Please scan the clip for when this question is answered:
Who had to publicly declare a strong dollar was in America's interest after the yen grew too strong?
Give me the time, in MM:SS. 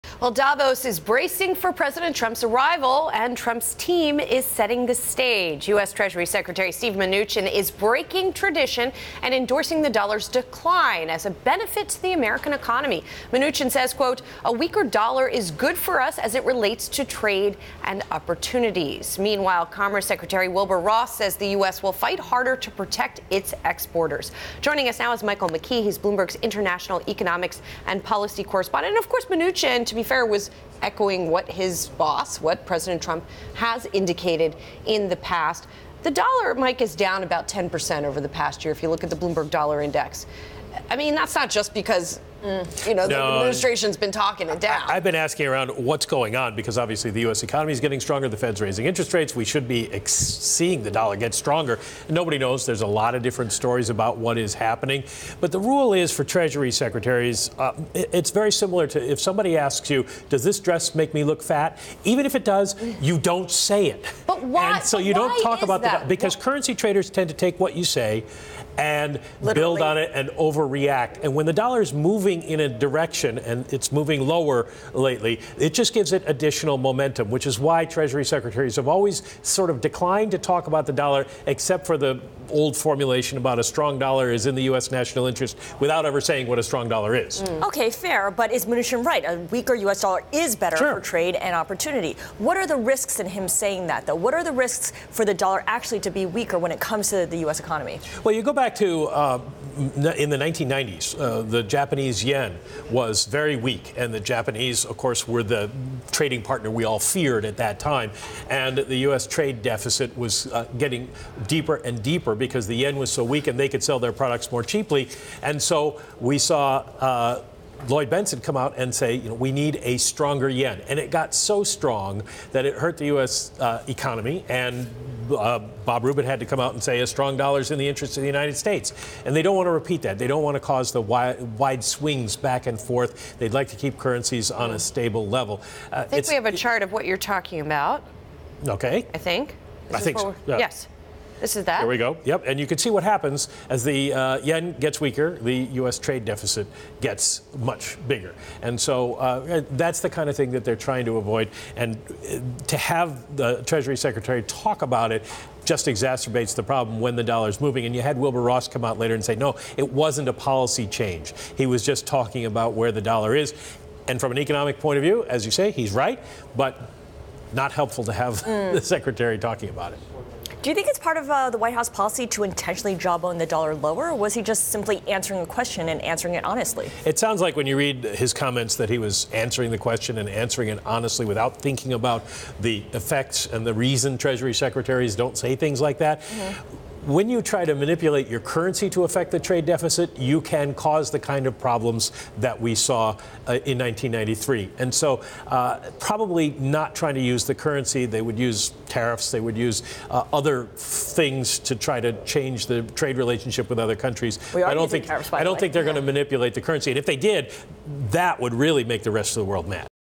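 02:05.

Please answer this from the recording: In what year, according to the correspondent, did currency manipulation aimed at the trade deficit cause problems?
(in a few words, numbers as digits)
1993.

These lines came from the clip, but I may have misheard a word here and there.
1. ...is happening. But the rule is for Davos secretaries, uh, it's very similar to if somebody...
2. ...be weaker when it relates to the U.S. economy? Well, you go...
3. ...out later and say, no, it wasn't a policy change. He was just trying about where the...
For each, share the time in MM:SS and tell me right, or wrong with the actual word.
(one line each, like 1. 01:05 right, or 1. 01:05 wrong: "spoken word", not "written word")
1. 00:54 wrong: "Treasury", not "Davos"
2. 01:36 wrong: "comes", not "relates"
3. 02:38 wrong: "talking", not "trying".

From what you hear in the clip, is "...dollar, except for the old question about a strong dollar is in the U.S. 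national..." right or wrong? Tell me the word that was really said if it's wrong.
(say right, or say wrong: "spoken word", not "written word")
wrong: "formulation", not "question".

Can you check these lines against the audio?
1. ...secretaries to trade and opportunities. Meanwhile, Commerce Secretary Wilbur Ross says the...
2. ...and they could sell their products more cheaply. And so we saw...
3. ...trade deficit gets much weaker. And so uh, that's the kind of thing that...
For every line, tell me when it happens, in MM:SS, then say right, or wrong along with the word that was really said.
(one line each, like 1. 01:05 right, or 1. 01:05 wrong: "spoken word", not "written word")
1. 00:16 wrong: "relates", not "secretaries"
2. 01:53 right
3. 02:25 wrong: "bigger", not "weaker".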